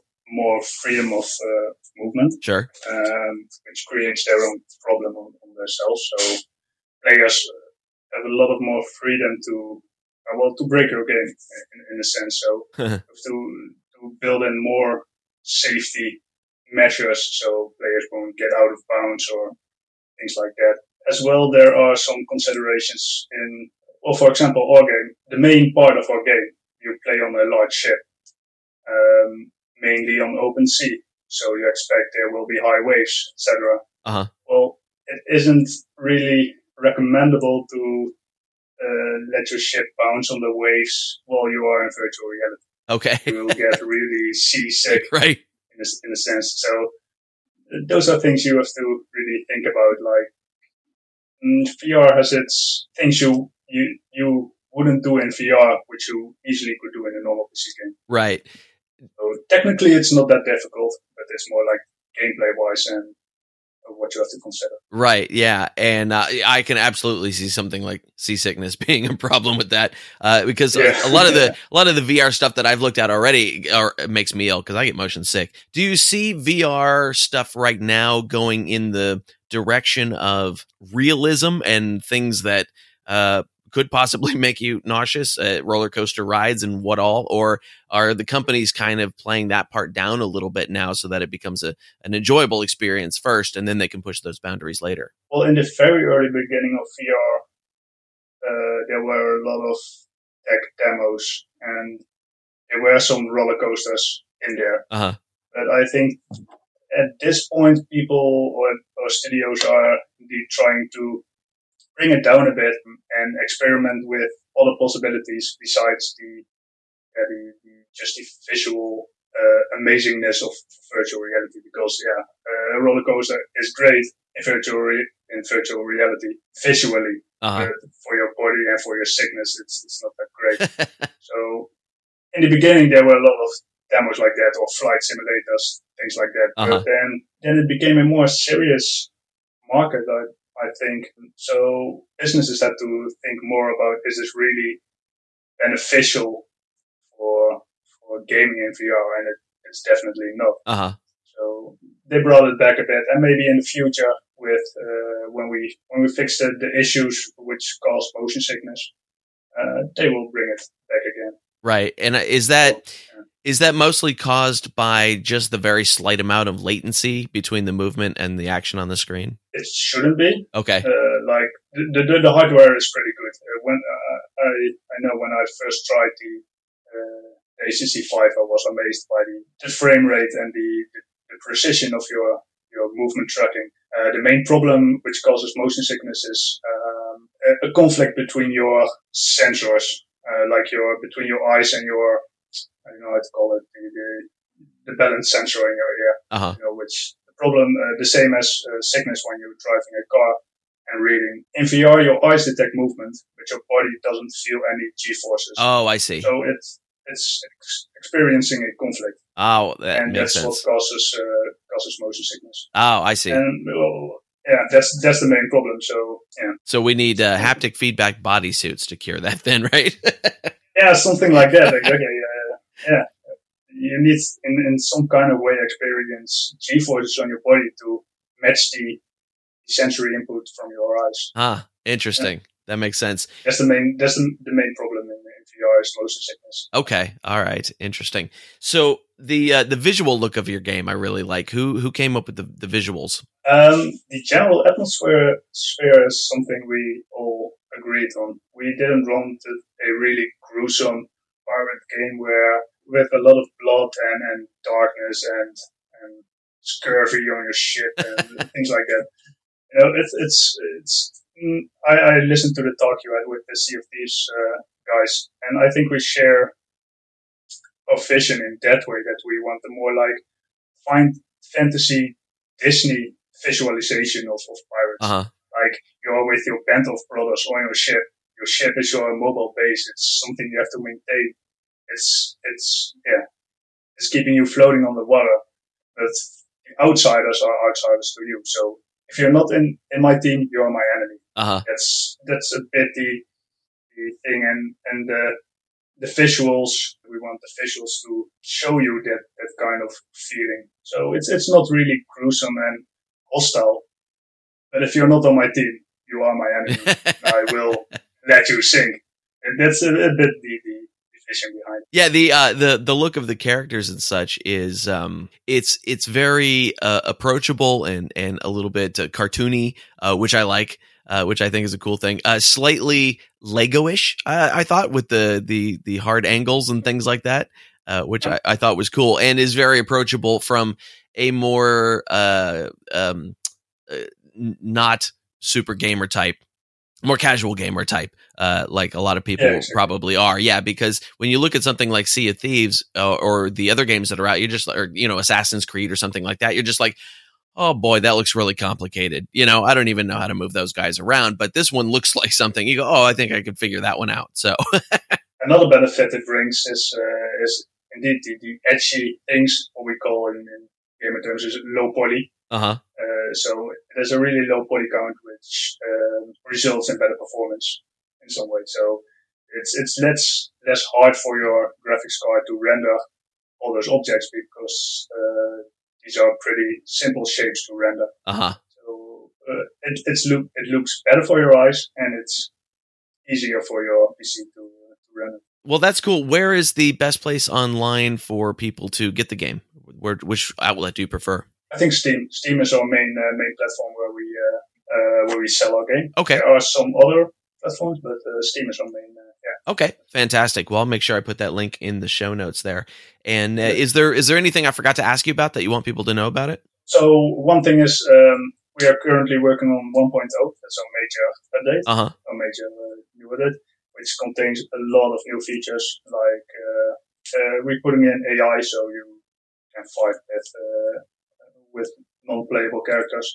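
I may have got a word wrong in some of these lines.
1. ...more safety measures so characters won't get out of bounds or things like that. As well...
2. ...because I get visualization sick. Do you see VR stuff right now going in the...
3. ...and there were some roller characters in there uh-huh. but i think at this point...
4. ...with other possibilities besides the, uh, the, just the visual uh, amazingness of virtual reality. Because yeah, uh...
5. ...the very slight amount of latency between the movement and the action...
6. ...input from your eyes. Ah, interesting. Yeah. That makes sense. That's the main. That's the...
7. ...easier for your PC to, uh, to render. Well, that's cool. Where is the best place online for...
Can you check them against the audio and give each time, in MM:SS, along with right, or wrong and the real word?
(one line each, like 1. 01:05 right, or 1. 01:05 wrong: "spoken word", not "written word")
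1. 00:14 wrong: "players", not "characters"
2. 01:14 wrong: "motion", not "visualization"
3. 01:41 wrong: "coasters", not "characters"
4. 01:54 right
5. 02:45 right
6. 03:50 right
7. 06:23 right.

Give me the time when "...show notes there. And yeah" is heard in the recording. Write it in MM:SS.
06:42.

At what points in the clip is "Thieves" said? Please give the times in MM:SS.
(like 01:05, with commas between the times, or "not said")
04:23, 05:42.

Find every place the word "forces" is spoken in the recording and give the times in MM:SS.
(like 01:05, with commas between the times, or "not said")
03:25, 03:46.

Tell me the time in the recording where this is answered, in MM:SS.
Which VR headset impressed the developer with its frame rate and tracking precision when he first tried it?
02:57.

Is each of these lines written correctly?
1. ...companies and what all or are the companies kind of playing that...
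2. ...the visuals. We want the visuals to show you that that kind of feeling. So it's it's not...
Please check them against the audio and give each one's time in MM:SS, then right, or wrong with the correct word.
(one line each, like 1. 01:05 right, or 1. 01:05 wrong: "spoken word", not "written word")
1. 01:26 wrong: "rides", not "companies"
2. 04:56 right.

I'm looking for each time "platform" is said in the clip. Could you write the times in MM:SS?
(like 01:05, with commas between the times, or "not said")
06:33, 06:37.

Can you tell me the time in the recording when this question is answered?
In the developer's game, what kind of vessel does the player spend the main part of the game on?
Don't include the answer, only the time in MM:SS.
00:27.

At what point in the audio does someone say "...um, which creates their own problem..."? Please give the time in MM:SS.
00:02.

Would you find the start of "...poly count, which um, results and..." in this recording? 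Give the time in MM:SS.
06:04.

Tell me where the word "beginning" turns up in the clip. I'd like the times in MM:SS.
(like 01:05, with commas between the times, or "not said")
01:36, 02:12.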